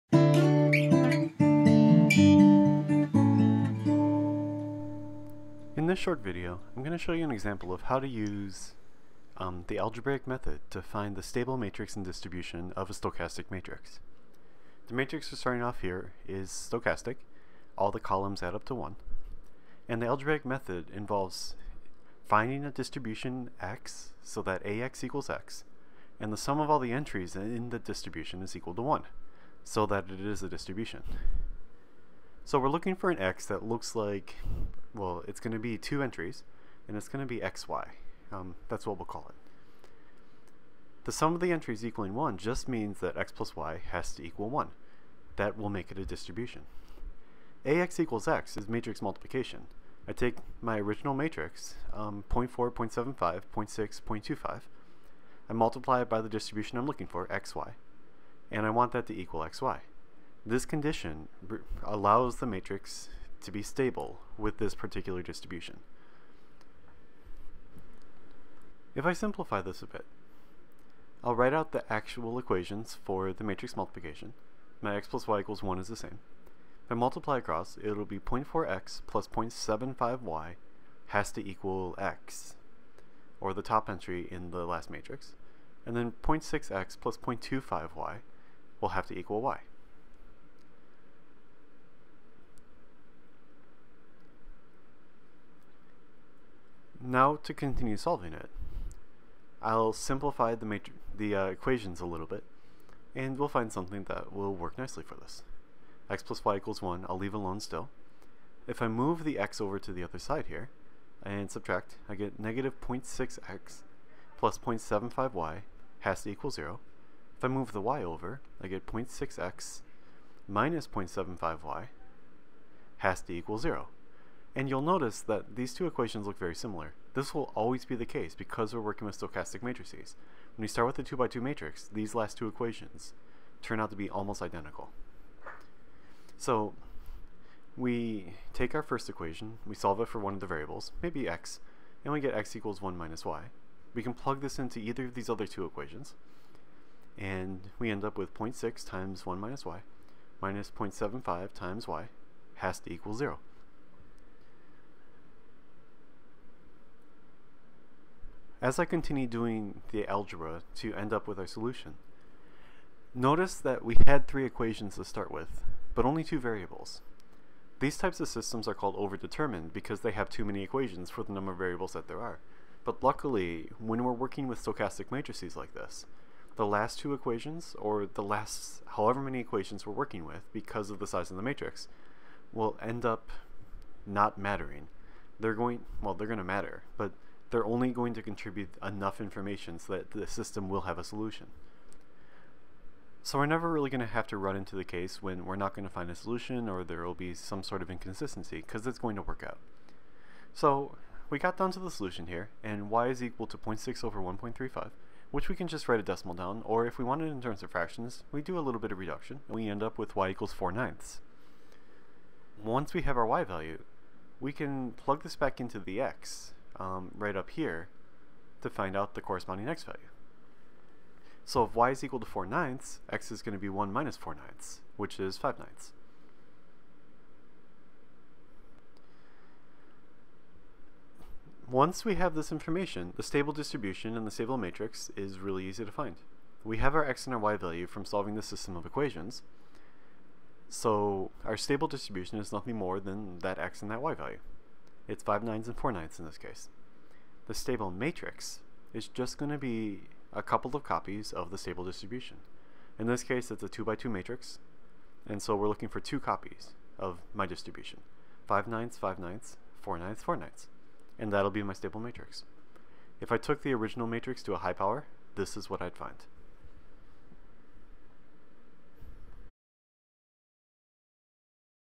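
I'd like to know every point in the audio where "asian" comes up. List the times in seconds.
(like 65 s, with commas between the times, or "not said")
not said.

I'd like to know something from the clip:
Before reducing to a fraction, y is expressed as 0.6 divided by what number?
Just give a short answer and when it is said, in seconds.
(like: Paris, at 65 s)
1.35, at 204 s.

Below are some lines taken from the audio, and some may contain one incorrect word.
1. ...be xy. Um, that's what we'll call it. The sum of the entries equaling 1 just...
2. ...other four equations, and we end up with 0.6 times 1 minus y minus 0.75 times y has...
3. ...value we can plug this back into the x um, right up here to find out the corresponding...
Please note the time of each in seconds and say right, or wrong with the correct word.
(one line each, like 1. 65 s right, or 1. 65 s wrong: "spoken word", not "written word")
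1. 37 s right
2. 145 s wrong: "two", not "four"
3. 213 s right.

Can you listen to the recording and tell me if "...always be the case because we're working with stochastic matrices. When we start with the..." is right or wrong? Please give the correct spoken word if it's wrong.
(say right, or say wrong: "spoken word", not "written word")
right.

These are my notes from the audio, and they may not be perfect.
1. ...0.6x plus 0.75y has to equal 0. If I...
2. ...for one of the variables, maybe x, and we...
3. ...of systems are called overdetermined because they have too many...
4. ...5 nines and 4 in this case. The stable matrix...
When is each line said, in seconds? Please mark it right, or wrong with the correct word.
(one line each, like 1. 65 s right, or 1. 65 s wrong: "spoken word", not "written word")
1. 112 s right
2. 140 s right
3. 168 s right
4. 245 s right.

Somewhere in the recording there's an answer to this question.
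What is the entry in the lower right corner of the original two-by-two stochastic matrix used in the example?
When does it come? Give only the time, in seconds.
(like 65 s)
54 s.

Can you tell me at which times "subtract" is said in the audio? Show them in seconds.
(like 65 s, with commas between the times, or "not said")
111 s.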